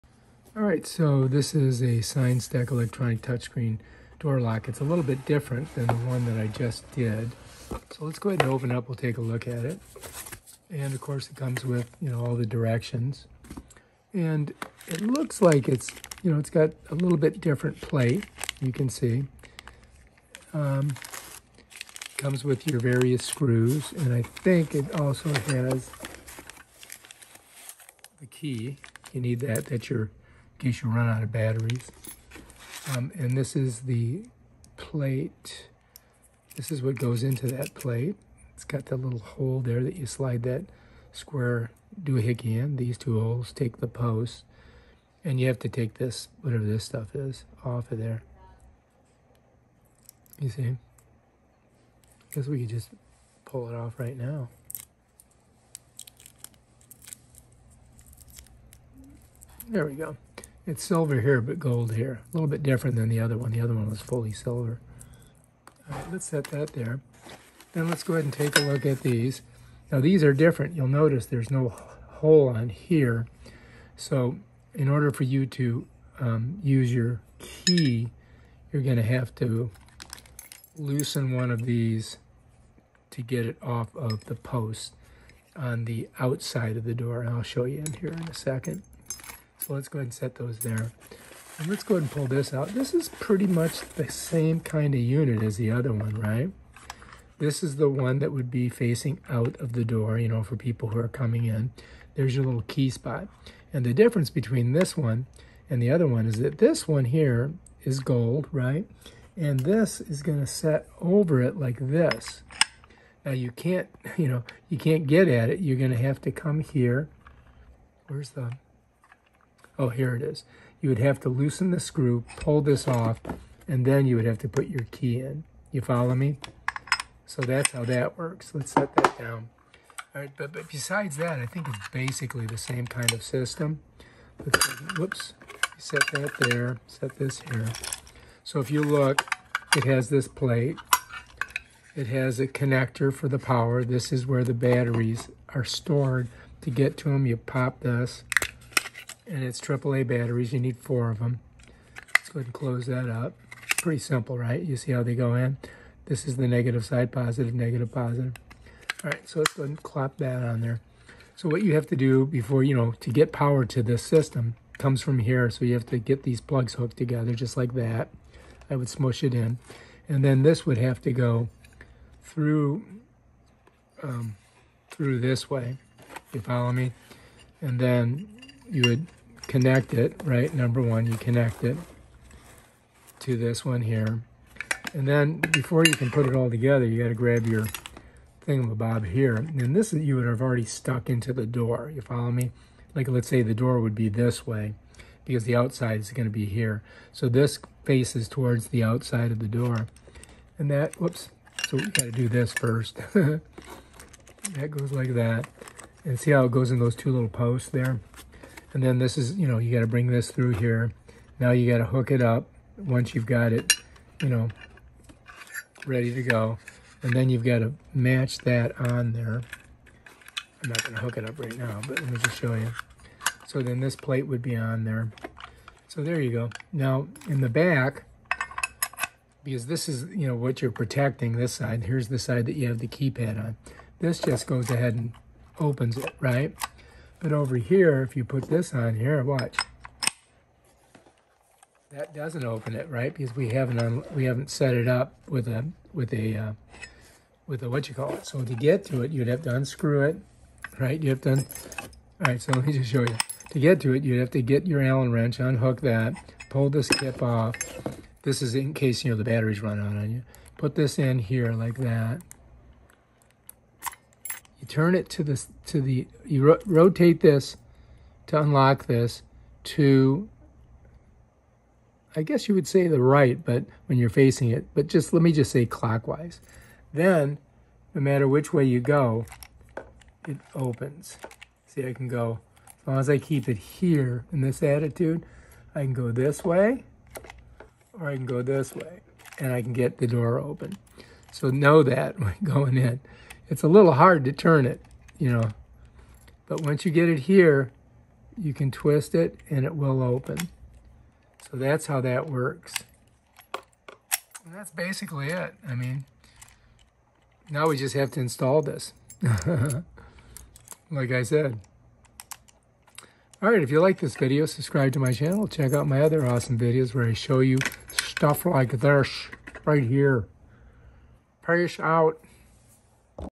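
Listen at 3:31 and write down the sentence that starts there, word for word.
Now you got to hook it up once you've got it, you know, ready to go.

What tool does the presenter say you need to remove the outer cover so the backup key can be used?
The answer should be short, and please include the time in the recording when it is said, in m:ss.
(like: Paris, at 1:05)
Allen wrench, at 4:14.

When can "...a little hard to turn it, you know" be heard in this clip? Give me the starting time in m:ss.
4:53.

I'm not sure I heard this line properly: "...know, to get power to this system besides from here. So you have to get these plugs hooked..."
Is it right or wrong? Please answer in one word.
wrong.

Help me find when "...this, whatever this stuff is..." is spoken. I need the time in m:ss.
0:45.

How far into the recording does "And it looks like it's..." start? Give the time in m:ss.
0:14.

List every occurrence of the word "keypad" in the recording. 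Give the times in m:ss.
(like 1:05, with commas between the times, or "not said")
3:52.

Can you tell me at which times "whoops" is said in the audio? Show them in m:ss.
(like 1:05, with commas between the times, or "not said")
2:14, 3:20.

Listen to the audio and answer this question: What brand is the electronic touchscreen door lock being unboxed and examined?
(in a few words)
Signstek.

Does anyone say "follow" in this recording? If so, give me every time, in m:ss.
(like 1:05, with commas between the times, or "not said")
2:05, 2:56, 3:12.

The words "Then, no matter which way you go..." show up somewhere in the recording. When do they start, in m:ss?
4:36.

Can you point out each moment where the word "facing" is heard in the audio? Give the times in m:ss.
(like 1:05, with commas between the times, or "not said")
1:38, 4:34.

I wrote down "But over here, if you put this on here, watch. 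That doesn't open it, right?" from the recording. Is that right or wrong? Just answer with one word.
right.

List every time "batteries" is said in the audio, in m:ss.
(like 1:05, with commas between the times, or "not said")
0:31, 2:24, 2:30, 4:19.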